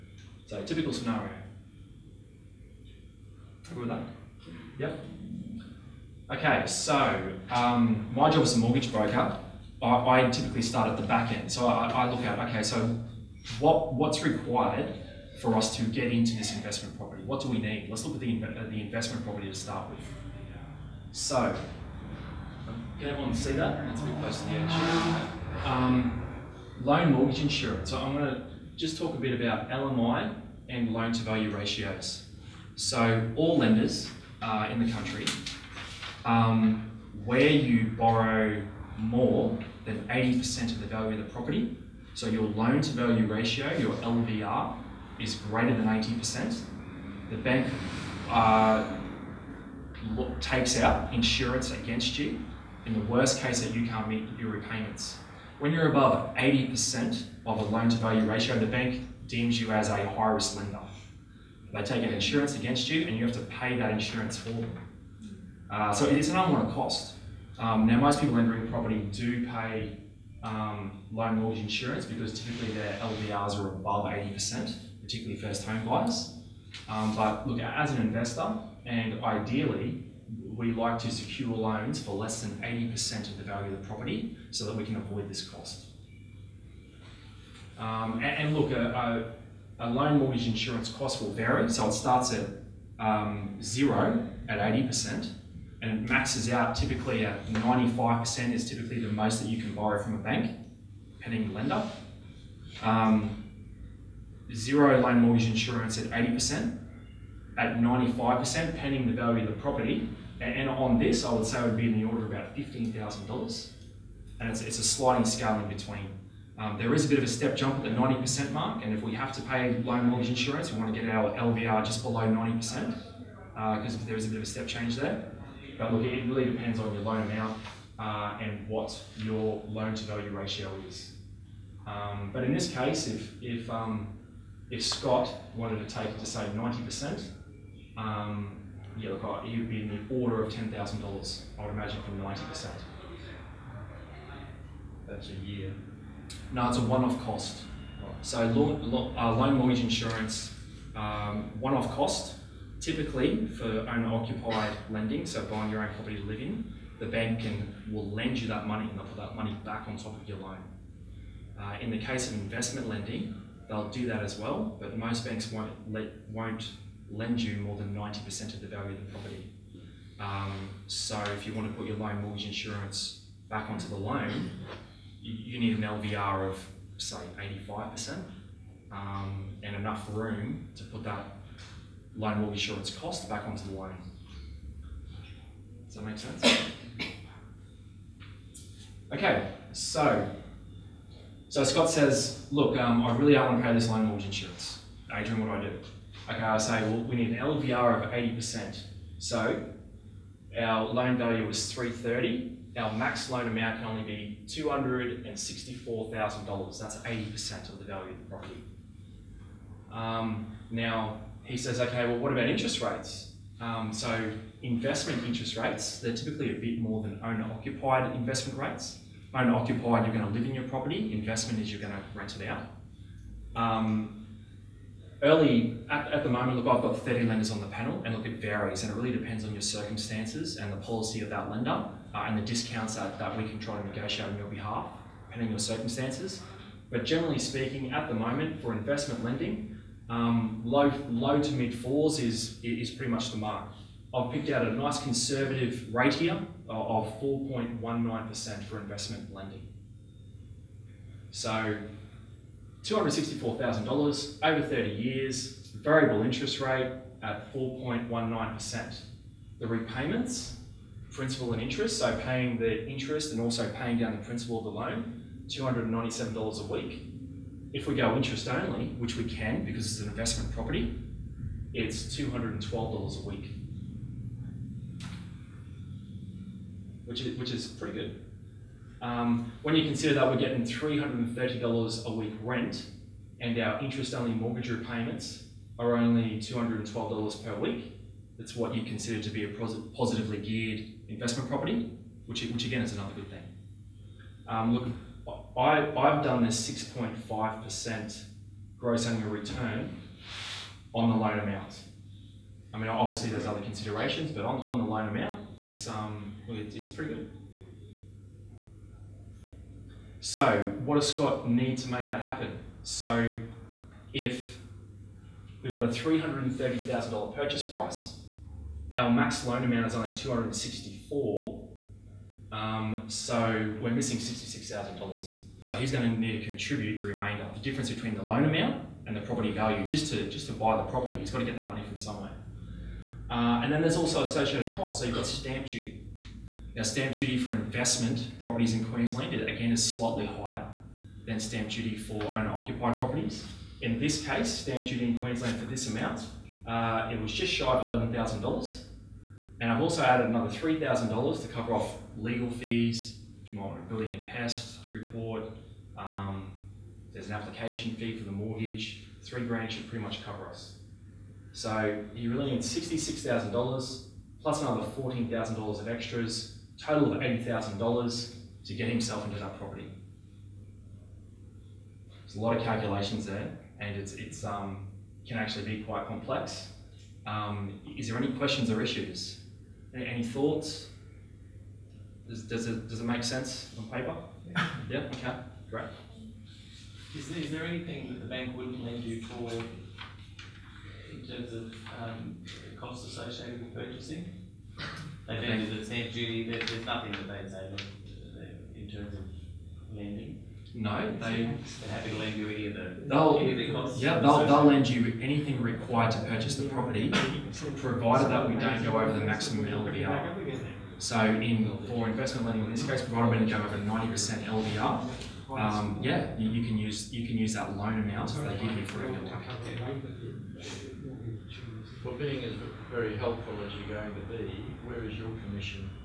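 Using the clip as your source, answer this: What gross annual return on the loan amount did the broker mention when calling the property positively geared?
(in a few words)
6.5%.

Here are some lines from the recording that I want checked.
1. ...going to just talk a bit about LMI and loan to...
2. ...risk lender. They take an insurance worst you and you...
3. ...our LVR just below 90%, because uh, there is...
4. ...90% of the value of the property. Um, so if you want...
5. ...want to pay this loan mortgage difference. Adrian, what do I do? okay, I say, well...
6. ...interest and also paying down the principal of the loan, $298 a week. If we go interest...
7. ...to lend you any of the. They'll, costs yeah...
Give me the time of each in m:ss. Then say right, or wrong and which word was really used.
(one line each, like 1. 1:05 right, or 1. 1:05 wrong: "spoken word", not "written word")
1. 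0:28 right
2. 1:00 wrong: "against", not "worst"
3. 2:01 right
4. 2:47 right
5. 3:13 wrong: "insurance", not "difference"
6. 4:22 wrong: "297", not "298"
7. 6:42 right.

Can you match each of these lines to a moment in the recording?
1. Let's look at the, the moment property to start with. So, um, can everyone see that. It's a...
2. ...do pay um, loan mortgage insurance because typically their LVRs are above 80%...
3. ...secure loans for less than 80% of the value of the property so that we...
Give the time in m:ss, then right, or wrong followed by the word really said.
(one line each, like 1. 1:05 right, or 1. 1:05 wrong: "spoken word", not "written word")
1. 0:17 wrong: "investment", not "moment"
2. 1:09 right
3. 1:21 right.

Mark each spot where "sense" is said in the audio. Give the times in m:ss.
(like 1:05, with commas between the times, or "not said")
3:06, 6:23.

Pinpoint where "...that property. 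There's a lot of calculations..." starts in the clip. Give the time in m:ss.
6:09.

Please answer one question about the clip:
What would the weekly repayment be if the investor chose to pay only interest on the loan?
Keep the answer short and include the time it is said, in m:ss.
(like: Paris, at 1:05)
$212 a week, at 4:32.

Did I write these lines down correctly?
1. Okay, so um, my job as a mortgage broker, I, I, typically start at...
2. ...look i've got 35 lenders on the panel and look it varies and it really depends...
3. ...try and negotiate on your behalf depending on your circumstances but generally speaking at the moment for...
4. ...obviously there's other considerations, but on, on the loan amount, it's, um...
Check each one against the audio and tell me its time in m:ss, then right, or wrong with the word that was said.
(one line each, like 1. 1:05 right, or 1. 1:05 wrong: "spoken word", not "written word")
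1. 0:06 right
2. 3:46 wrong: "30", not "35"
3. 3:53 right
4. 5:02 right.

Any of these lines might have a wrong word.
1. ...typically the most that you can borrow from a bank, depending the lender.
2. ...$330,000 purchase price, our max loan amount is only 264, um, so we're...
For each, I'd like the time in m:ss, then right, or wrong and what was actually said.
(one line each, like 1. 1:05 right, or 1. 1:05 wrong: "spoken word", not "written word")
1. 1:38 right
2. 5:15 right.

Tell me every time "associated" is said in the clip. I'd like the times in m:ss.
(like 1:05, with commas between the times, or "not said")
5:34, 6:33.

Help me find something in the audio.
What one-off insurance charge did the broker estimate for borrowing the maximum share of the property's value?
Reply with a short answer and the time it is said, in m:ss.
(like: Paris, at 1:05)
$15,000, at 1:52.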